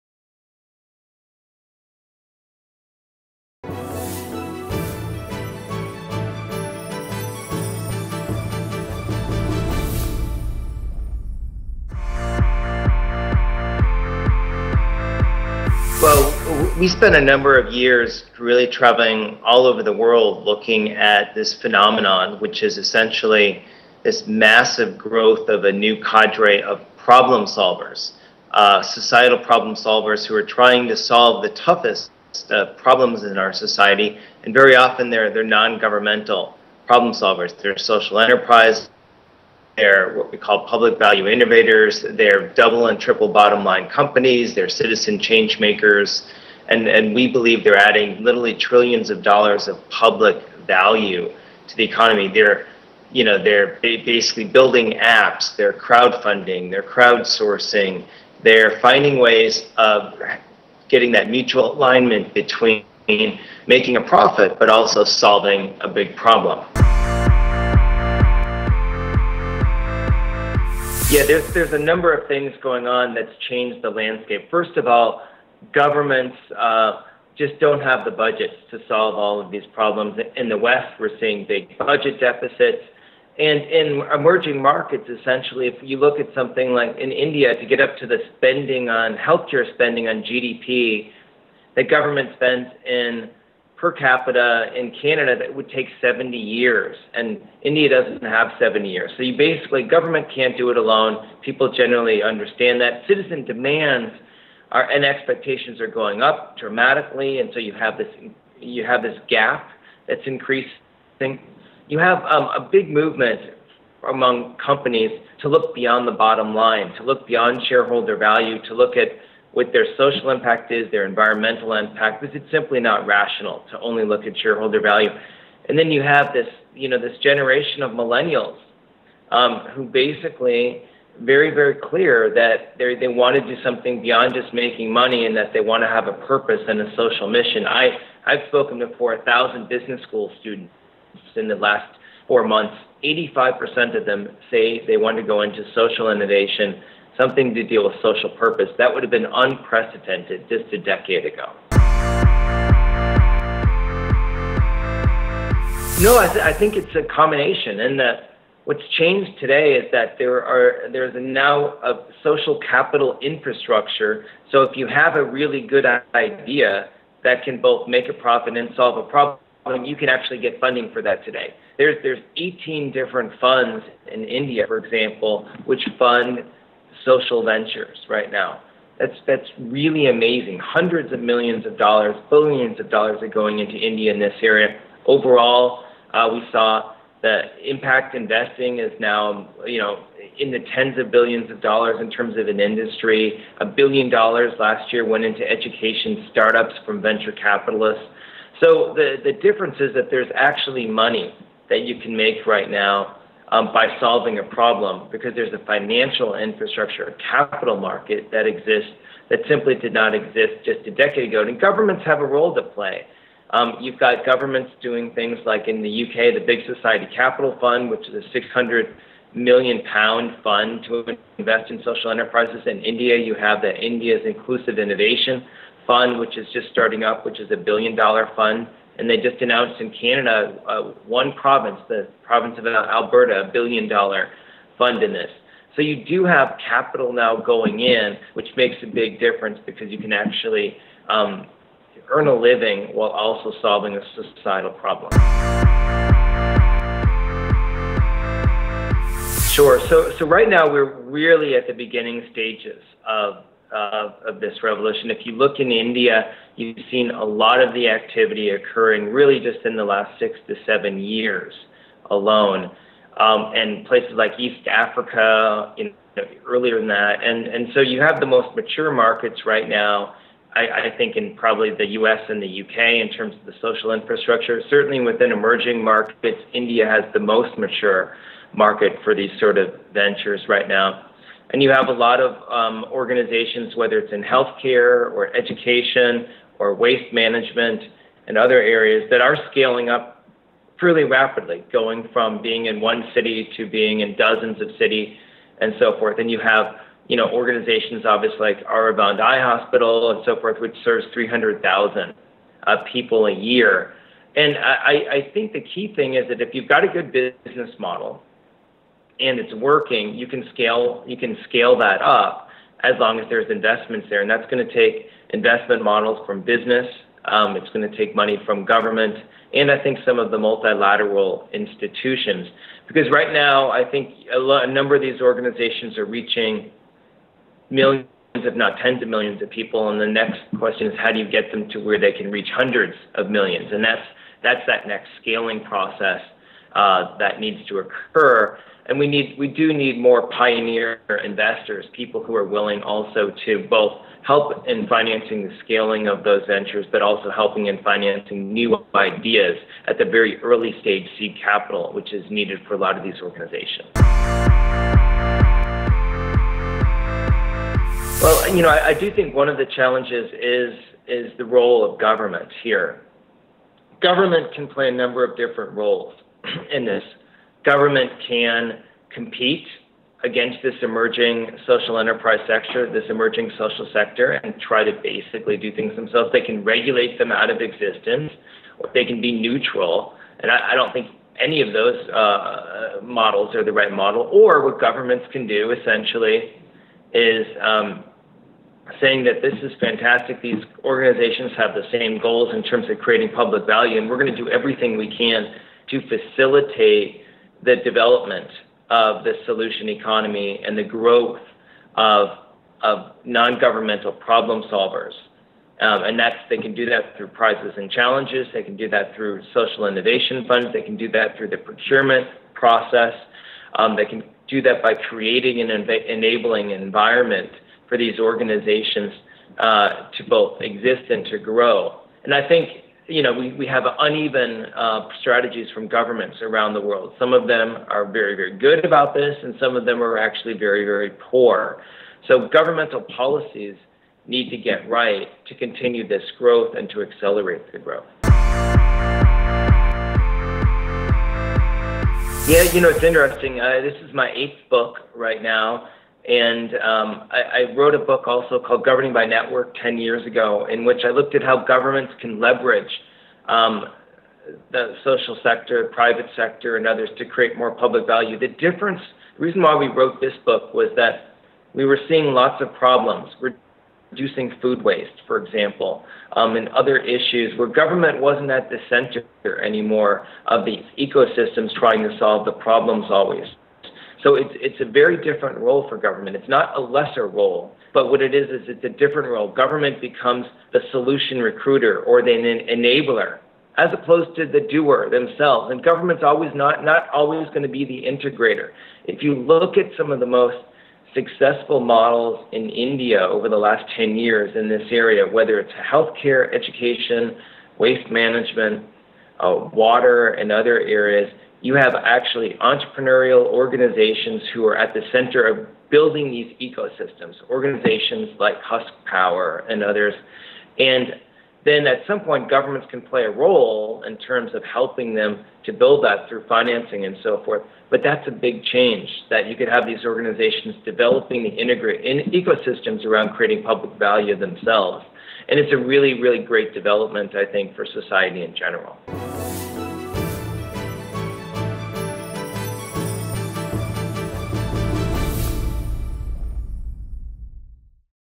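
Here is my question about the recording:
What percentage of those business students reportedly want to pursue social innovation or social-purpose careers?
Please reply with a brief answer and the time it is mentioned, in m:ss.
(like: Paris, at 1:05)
85%, at 2:23.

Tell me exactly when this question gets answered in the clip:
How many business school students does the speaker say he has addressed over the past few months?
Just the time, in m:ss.
2:18.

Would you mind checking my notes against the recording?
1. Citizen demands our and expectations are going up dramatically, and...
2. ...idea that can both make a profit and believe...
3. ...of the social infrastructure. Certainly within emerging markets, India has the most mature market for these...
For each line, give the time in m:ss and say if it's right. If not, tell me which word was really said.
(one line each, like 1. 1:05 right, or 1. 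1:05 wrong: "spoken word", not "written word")
1. 1:43 right
2. 2:46 wrong: "solve", not "believe"
3. 4:33 right.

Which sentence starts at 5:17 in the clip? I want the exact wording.
Um, it's going to take money from government, and I think some of the multilateral institutions.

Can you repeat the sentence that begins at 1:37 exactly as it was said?
And India doesn't have 70 years.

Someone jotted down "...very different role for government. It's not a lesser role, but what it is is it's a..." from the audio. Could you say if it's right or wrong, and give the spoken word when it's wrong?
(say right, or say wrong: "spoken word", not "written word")
right.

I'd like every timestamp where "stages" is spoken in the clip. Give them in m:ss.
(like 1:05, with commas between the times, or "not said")
4:12, 5:50.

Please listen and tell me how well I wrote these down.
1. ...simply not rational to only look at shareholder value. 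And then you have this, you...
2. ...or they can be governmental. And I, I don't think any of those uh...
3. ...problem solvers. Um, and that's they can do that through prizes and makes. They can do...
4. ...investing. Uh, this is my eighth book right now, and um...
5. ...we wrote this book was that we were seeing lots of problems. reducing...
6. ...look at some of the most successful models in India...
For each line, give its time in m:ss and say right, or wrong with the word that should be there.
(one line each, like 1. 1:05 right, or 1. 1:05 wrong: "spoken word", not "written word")
1. 2:02 right
2. 6:18 wrong: "neutral", not "governmental"
3. 6:44 wrong: "challenges", not "makes"
4. 7:23 wrong: "interesting", not "investing"
5. 7:39 right
6. 8:09 right.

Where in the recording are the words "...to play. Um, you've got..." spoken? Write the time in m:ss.
3:32.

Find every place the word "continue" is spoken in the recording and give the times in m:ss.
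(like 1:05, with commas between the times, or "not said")
7:15.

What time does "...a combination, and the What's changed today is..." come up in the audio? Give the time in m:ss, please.
2:36.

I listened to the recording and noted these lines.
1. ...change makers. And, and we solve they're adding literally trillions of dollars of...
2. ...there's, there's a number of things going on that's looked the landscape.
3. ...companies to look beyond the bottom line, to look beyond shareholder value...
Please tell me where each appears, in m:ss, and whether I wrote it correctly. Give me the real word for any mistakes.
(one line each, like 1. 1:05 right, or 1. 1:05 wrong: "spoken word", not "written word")
1. 0:45 wrong: "believe", not "solve"
2. 1:11 wrong: "changed", not "looked"
3. 1:54 right.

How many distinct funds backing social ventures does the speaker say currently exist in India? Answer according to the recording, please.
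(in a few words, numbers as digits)
18.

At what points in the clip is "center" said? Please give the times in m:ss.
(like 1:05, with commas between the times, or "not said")
7:48, 8:25.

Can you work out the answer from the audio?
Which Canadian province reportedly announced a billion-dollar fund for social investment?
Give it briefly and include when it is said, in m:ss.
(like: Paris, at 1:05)
Alberta, at 3:52.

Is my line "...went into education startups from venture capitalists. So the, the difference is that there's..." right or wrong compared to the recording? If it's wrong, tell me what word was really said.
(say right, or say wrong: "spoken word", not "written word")
right.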